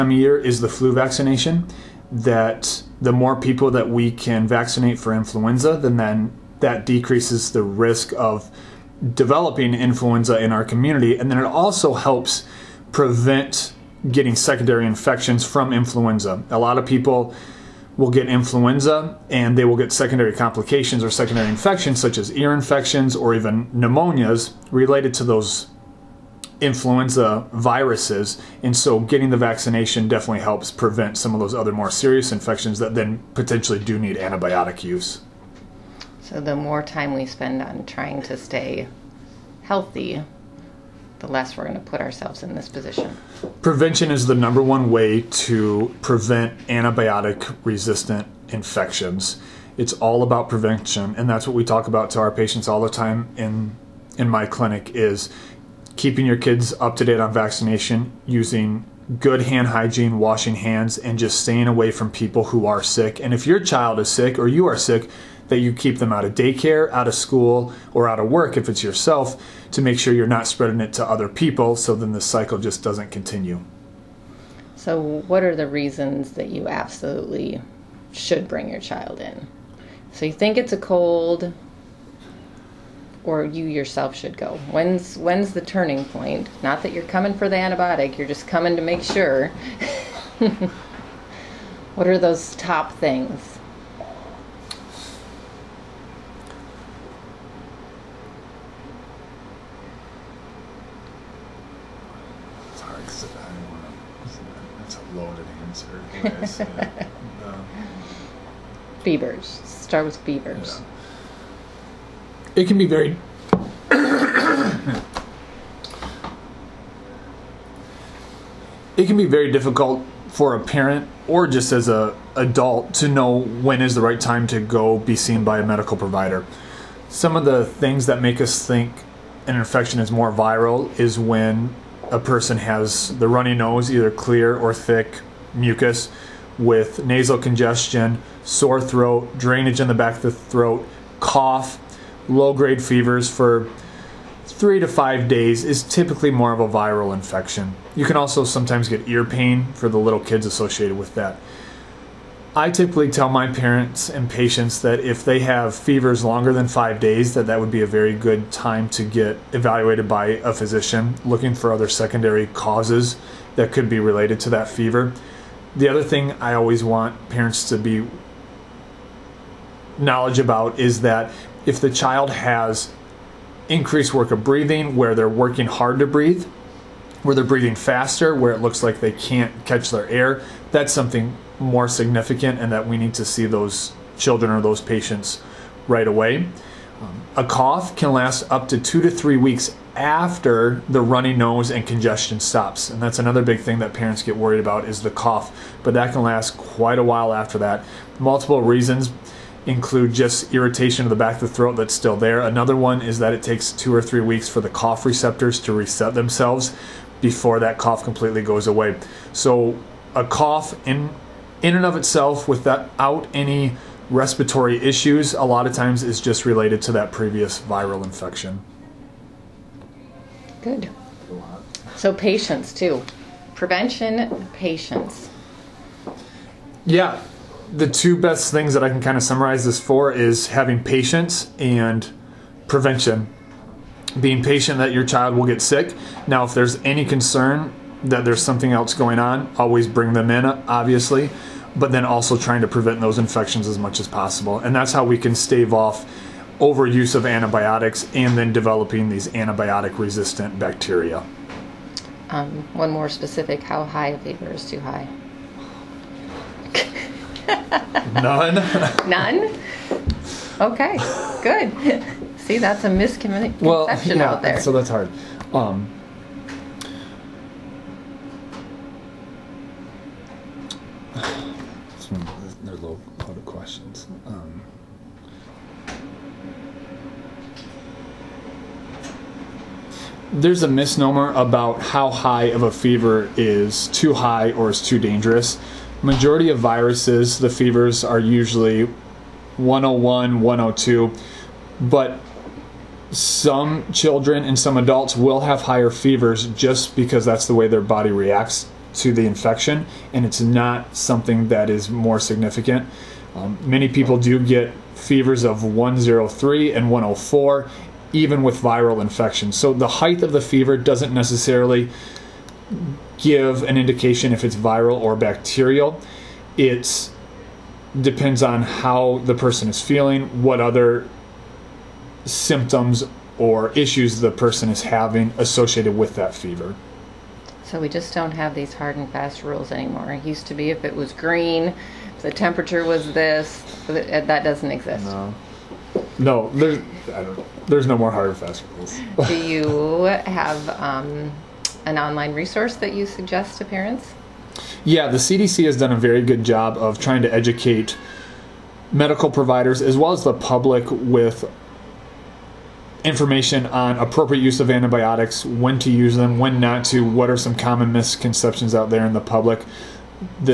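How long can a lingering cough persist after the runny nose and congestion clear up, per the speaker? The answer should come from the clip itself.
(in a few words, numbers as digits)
2 to 3 weeks.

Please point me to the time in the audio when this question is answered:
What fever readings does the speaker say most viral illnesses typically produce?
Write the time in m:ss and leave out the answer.
4:49.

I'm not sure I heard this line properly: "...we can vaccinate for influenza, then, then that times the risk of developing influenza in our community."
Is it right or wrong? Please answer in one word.
wrong.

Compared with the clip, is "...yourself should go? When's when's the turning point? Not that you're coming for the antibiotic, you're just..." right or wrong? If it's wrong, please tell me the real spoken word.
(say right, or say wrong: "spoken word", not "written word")
right.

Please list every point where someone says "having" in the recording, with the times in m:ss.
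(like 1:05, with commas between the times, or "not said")
3:50, 5:24.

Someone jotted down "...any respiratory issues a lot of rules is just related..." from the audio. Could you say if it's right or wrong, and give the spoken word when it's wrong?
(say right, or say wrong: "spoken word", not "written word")
wrong: "times", not "rules".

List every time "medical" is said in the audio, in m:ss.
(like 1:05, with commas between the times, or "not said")
2:05, 5:48.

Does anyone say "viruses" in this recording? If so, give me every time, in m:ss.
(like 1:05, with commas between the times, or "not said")
0:27, 4:46.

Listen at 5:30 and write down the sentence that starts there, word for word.
It used to be if it was green, the temperature was this, uh, that doesn't exist.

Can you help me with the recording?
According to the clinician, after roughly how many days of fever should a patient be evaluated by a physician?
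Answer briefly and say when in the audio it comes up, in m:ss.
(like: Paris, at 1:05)
5 days, at 2:36.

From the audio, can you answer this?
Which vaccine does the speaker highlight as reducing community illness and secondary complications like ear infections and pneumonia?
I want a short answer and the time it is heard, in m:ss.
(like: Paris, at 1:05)
flu vaccination, at 0:00.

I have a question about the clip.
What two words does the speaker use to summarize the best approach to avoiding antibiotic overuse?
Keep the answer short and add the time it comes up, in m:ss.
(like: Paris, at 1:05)
patience and prevention, at 3:50.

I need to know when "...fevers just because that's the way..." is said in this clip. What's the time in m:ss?
4:55.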